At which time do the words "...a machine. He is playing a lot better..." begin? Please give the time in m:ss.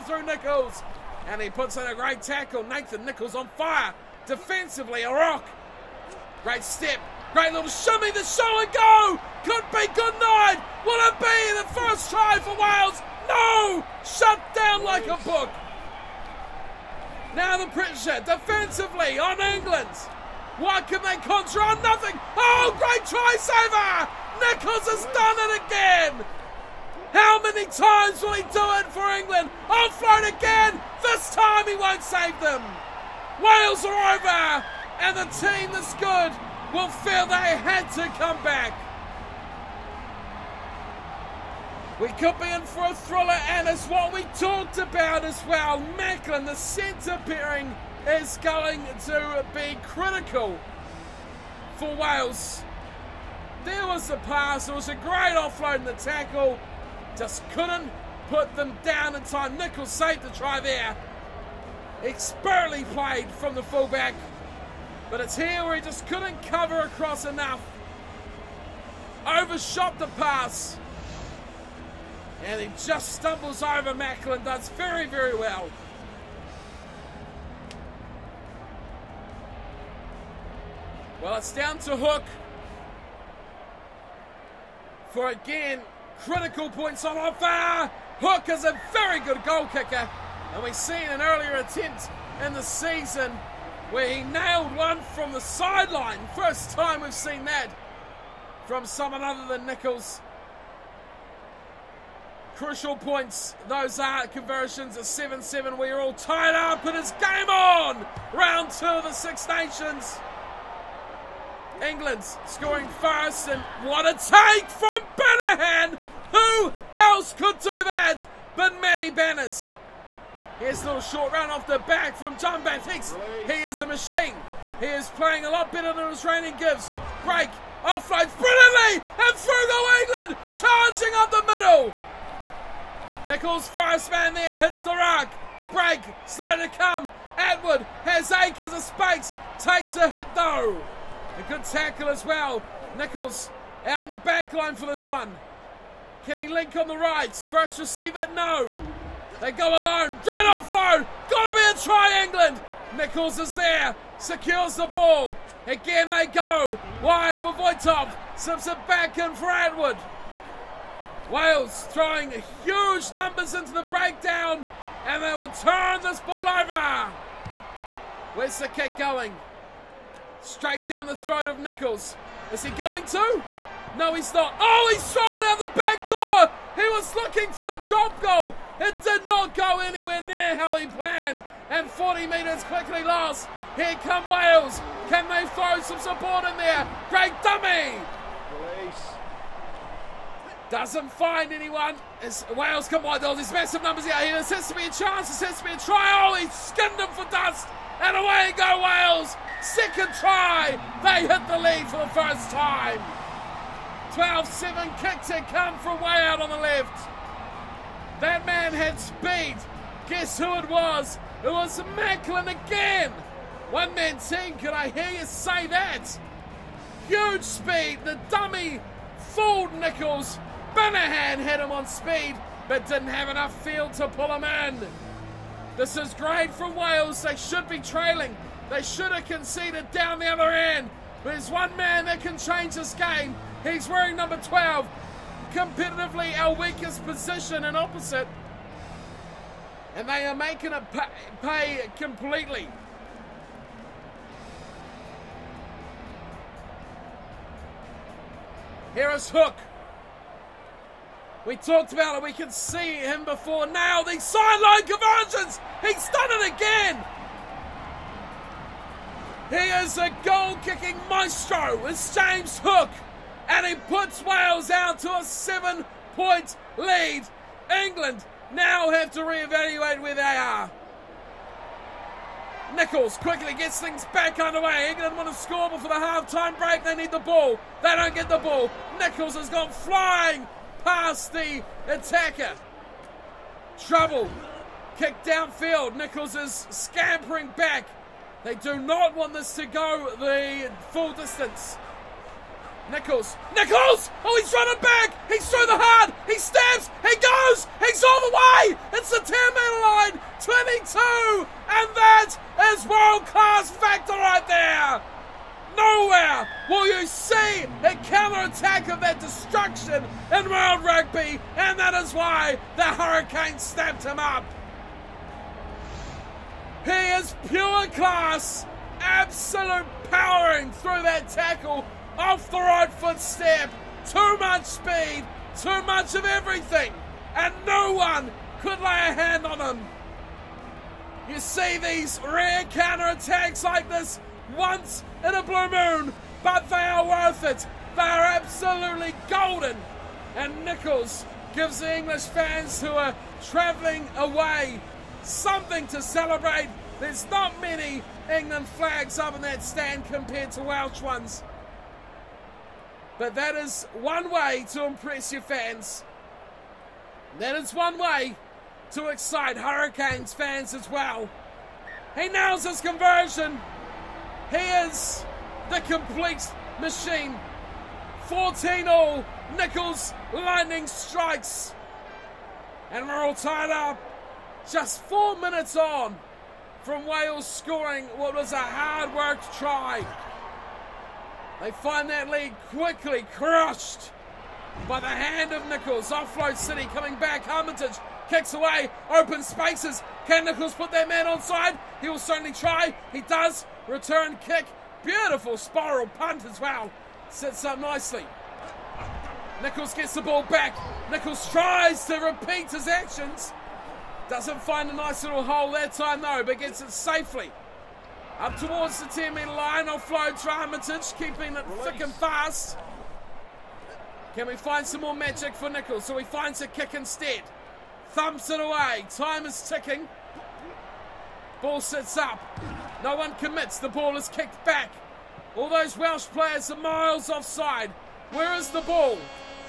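2:03.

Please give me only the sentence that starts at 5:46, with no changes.
There's not many England flags up in that stand compared to Welsh ones.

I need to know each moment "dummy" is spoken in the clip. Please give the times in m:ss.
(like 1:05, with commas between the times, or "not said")
3:07, 3:38.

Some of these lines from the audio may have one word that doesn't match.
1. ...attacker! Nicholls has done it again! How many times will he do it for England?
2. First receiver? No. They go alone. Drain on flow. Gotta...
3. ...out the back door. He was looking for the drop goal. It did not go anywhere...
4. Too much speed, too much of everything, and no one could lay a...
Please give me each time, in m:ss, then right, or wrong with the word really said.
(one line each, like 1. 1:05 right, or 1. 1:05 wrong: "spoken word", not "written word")
1. 0:23 wrong: "saver", not "attacker"
2. 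2:27 right
3. 2:55 right
4. 5:24 right.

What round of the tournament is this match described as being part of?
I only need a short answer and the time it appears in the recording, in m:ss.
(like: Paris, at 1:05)
Round two, at 1:48.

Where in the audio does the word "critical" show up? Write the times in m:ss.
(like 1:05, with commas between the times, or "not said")
0:49, 1:26.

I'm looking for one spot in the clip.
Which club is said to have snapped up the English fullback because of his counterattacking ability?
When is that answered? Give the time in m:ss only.
5:12.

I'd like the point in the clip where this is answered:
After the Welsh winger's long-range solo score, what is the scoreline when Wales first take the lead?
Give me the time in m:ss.
3:24.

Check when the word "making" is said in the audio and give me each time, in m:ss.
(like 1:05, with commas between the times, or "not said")
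4:00.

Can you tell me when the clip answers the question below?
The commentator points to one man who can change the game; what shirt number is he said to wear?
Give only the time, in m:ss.
3:54.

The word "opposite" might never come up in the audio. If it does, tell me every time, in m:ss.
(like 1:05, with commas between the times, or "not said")
3:57.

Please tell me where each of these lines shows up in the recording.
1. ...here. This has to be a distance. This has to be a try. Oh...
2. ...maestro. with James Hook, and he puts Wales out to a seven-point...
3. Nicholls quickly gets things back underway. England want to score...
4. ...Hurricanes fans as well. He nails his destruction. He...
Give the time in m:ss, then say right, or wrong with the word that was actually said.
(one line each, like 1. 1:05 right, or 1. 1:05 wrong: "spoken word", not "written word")
1. 3:14 wrong: "chance", not "distance"
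2. 4:21 right
3. 4:32 right
4. 5:59 wrong: "conversion", not "destruction".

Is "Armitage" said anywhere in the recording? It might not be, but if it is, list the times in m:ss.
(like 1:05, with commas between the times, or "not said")
6:27, 6:50.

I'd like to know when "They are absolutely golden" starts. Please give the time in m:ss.
5:37.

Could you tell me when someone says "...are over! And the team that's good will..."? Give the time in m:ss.
0:33.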